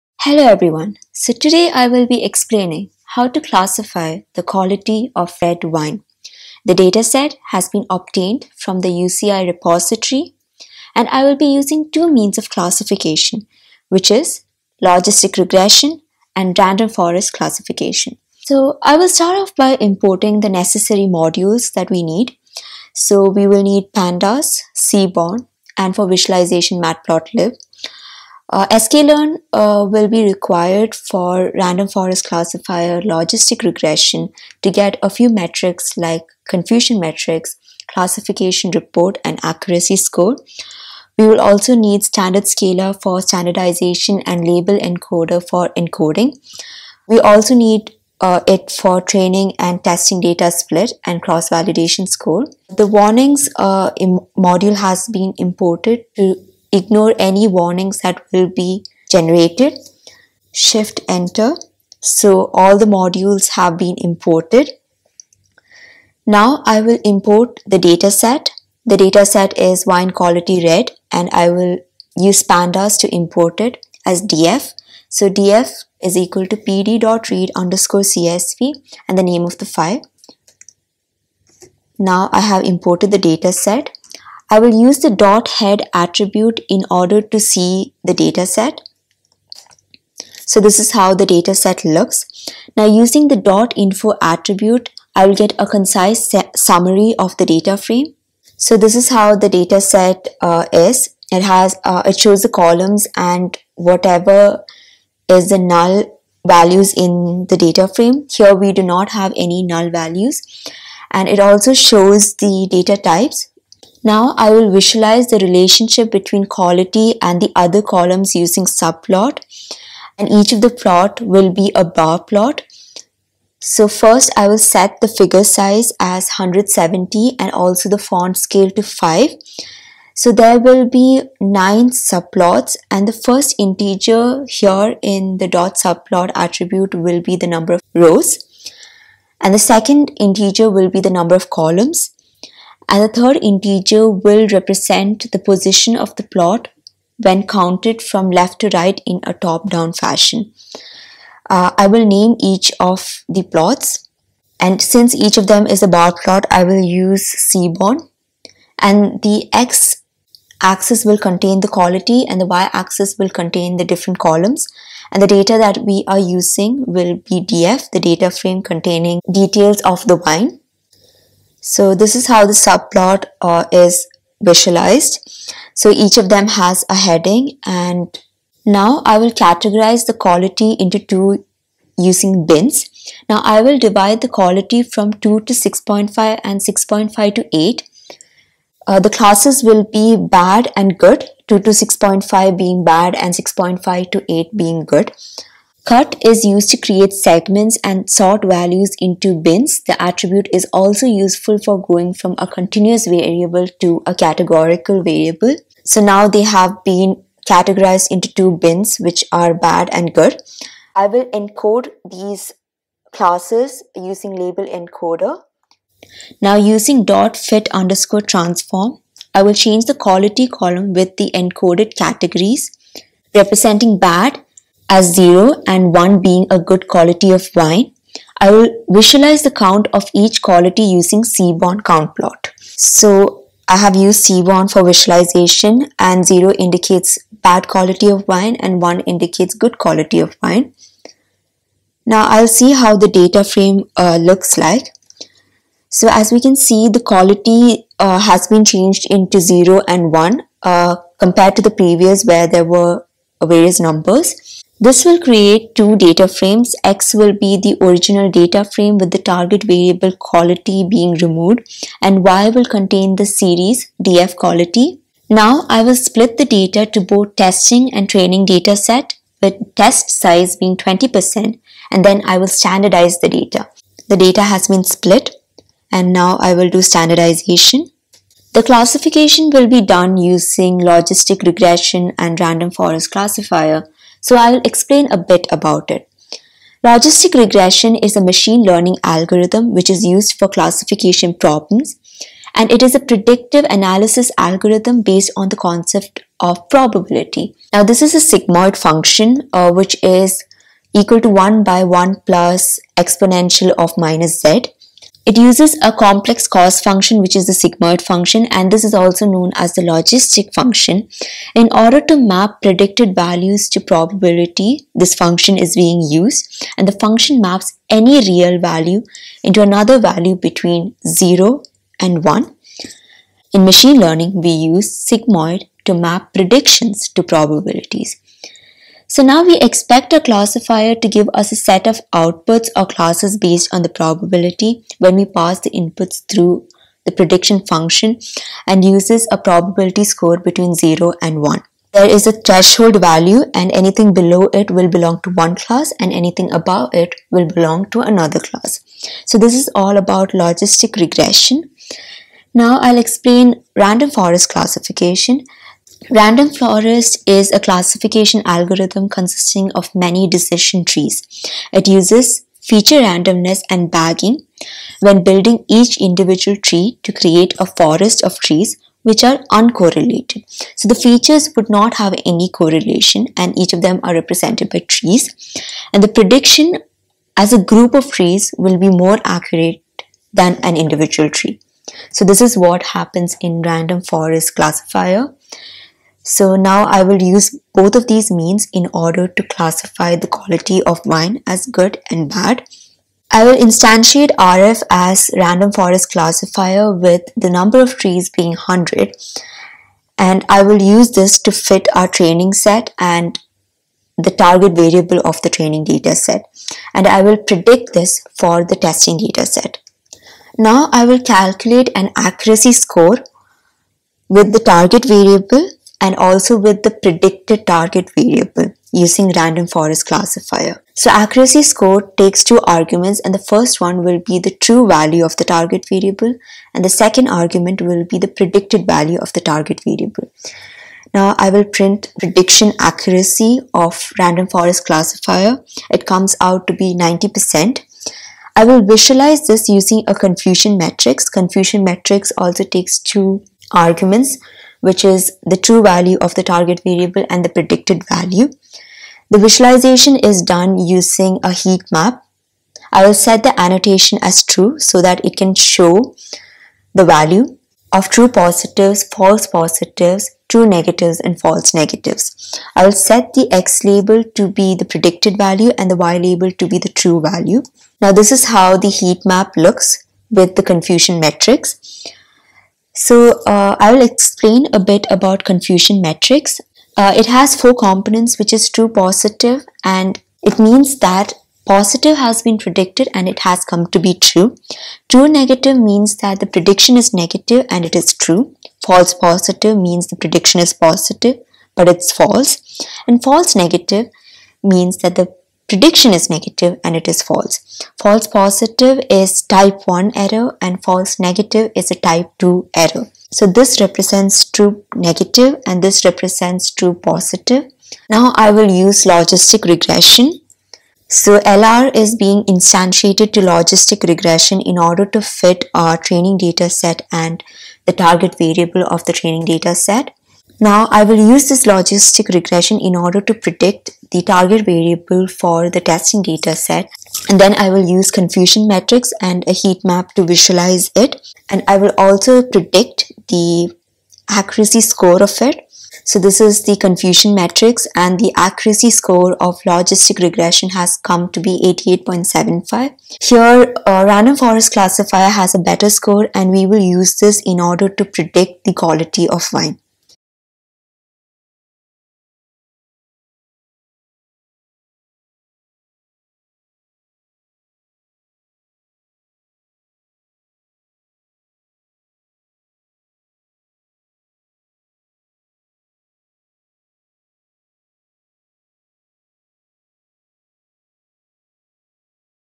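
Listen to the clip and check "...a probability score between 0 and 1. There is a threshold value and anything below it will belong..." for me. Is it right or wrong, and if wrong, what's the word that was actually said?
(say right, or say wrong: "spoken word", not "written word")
right.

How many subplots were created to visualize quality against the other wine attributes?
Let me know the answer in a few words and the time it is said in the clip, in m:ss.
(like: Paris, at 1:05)
9, at 2:11.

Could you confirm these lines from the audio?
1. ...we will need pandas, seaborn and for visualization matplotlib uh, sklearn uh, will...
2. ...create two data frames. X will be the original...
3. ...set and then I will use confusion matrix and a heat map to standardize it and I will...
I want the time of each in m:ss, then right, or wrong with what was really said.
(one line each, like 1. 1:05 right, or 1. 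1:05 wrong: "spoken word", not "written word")
1. 0:23 right
2. 4:15 right
3. 8:46 wrong: "visualize", not "standardize".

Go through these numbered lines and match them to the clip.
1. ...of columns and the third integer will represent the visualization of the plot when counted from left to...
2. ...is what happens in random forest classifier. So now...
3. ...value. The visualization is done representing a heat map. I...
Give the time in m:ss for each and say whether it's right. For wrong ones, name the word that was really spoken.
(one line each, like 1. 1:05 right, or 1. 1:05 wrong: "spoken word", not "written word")
1. 2:21 wrong: "position", not "visualization"
2. 6:22 right
3. 7:28 wrong: "using", not "representing".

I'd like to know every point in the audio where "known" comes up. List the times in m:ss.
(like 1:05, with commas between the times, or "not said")
5:09.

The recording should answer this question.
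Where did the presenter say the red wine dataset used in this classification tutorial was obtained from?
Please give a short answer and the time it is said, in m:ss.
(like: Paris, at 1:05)
UCI repository, at 0:08.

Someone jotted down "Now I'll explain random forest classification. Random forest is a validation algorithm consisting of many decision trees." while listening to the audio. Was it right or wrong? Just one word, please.
wrong.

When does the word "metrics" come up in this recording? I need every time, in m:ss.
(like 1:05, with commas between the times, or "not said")
0:35.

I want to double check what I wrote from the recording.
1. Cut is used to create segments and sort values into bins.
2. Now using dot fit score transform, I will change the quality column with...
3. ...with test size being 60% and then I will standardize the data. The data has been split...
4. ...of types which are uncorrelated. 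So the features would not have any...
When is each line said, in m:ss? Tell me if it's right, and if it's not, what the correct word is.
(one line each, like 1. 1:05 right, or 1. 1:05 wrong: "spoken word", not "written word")
1. 3:15 right
2. 3:36 wrong: "underscore", not "score"
3. 4:29 wrong: "20", not "60"
4. 6:08 wrong: "trees", not "types".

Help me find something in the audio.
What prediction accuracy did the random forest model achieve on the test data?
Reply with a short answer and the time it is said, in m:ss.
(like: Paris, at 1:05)
90%, at 7:16.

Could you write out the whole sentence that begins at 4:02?
Now I'll see how the data frame uh, looks like.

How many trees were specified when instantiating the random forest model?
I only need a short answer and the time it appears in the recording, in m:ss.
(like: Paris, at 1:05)
100, at 6:38.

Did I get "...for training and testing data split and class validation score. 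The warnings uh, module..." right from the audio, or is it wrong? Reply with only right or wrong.
wrong.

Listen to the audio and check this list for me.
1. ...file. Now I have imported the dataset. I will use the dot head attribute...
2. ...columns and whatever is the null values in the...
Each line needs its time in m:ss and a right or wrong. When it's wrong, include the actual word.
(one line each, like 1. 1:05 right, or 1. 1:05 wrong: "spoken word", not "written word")
1. 1:19 right
2. 1:42 right.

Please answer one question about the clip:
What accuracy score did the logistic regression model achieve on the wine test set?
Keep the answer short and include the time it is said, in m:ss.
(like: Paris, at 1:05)
88.75, at 9:01.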